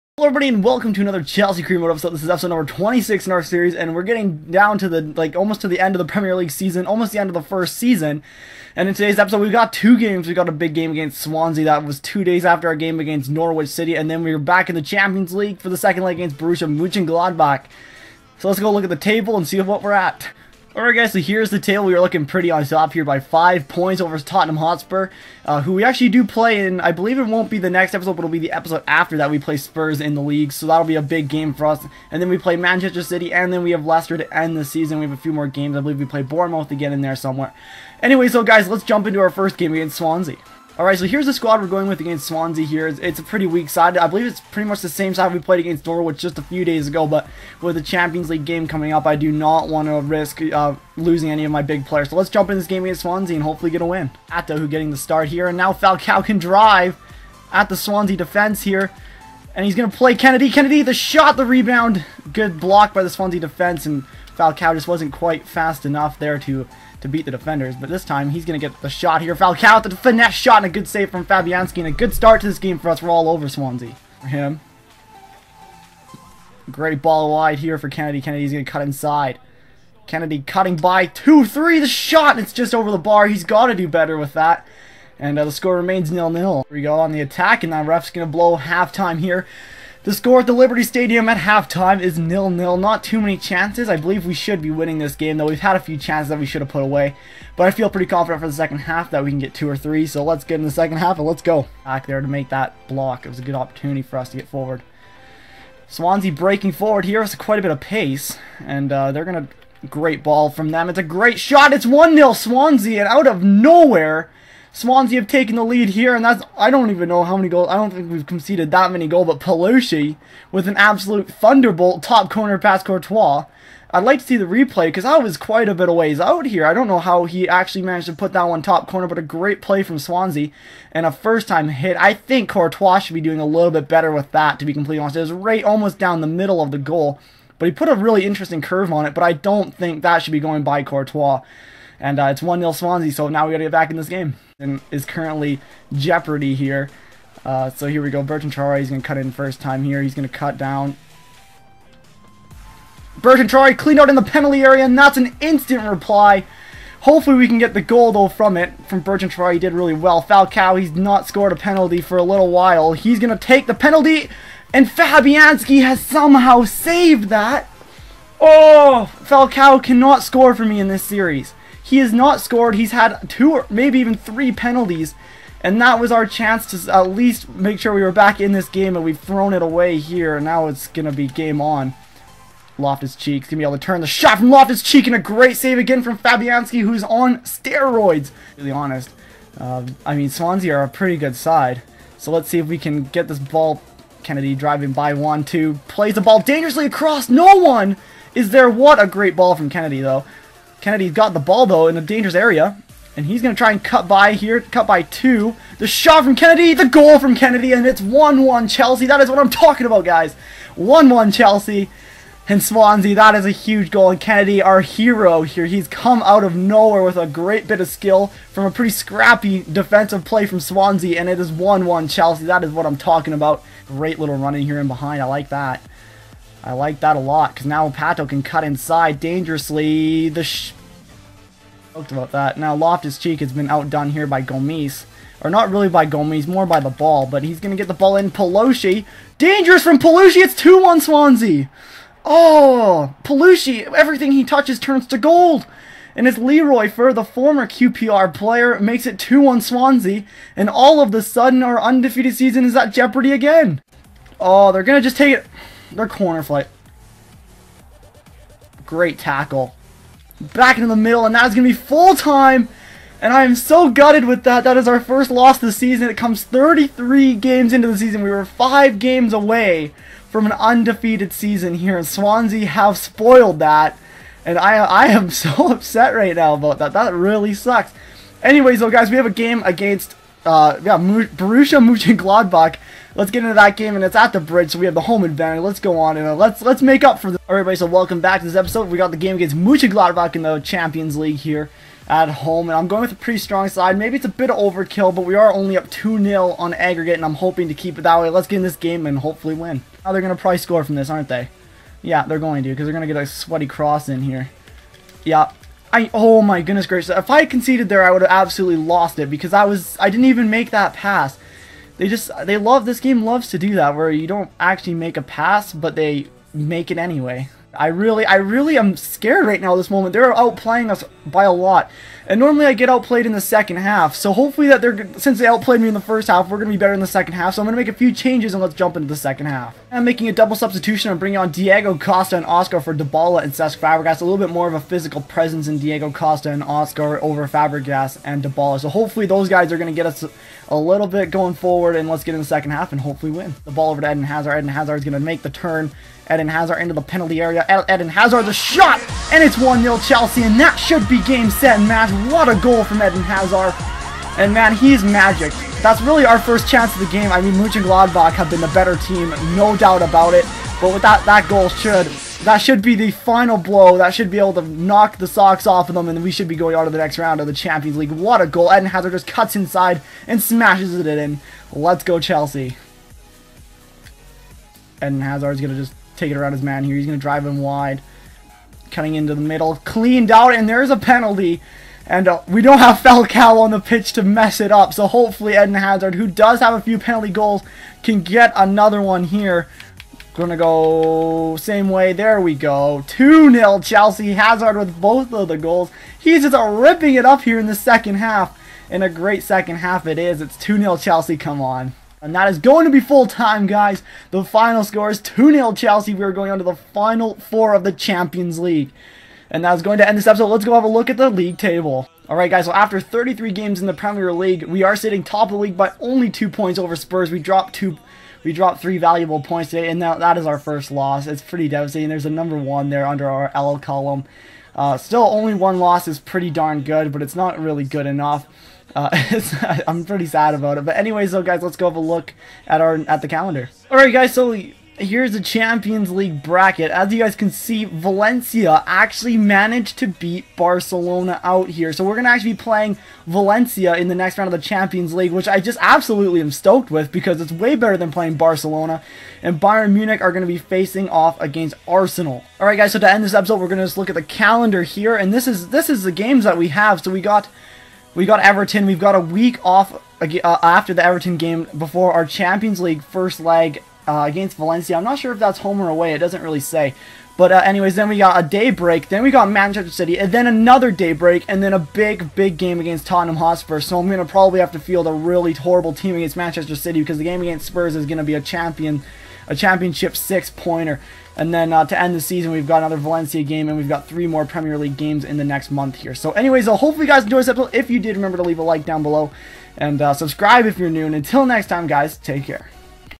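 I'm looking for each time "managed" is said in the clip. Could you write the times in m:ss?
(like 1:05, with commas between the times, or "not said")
2:07, 7:19.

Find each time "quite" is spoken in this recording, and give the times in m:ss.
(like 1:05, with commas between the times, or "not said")
1:05, 1:47, 2:05.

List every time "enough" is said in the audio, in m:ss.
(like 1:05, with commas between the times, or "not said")
1:05, 7:08.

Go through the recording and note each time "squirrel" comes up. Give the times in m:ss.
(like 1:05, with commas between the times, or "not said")
not said.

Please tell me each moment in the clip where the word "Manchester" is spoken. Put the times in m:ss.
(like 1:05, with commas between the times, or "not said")
0:32, 7:49, 7:56.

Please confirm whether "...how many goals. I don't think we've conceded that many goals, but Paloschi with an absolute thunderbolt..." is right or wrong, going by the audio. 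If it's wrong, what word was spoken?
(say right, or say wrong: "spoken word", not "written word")
right.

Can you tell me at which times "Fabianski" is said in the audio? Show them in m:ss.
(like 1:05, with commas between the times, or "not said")
1:11, 2:44, 3:06.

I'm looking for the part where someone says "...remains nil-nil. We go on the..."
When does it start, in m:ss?
1:25.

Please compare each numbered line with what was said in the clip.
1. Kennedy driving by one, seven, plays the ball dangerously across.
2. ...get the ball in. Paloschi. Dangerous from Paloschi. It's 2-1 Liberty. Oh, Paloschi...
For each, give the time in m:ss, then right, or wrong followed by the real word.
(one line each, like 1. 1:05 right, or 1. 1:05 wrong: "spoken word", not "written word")
1. 3:14 wrong: "two", not "seven"
2. 3:57 wrong: "Swansea", not "Liberty".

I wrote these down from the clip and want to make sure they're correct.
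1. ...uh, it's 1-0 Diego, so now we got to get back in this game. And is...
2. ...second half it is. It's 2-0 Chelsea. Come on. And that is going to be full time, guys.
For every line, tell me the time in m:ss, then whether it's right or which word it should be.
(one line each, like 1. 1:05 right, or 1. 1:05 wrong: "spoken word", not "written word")
1. 2:22 wrong: "Swansea", not "Diego"
2. 6:39 right.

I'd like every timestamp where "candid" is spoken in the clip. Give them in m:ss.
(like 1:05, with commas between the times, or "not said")
not said.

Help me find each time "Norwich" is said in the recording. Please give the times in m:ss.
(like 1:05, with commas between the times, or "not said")
0:13, 0:45.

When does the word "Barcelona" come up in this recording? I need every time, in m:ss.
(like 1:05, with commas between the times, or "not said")
7:20, 7:28.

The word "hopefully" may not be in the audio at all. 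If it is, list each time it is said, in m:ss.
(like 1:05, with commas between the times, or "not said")
0:53, 2:37, 4:59, 5:24, 5:38, 5:43, 6:25, 8:06.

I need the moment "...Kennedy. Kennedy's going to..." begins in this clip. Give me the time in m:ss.
1:17.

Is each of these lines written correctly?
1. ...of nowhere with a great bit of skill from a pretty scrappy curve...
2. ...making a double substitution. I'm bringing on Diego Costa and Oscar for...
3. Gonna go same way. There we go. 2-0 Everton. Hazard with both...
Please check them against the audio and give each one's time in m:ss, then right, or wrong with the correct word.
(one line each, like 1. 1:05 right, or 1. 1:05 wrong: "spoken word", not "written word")
1. 3:36 wrong: "defensive", not "curve"
2. 5:30 right
3. 6:30 wrong: "Chelsea", not "Everton".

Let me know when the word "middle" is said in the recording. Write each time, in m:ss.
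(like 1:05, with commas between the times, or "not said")
2:16, 4:20, 6:19.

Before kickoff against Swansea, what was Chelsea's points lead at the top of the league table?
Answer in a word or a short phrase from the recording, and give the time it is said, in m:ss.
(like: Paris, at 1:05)
5 points, at 0:23.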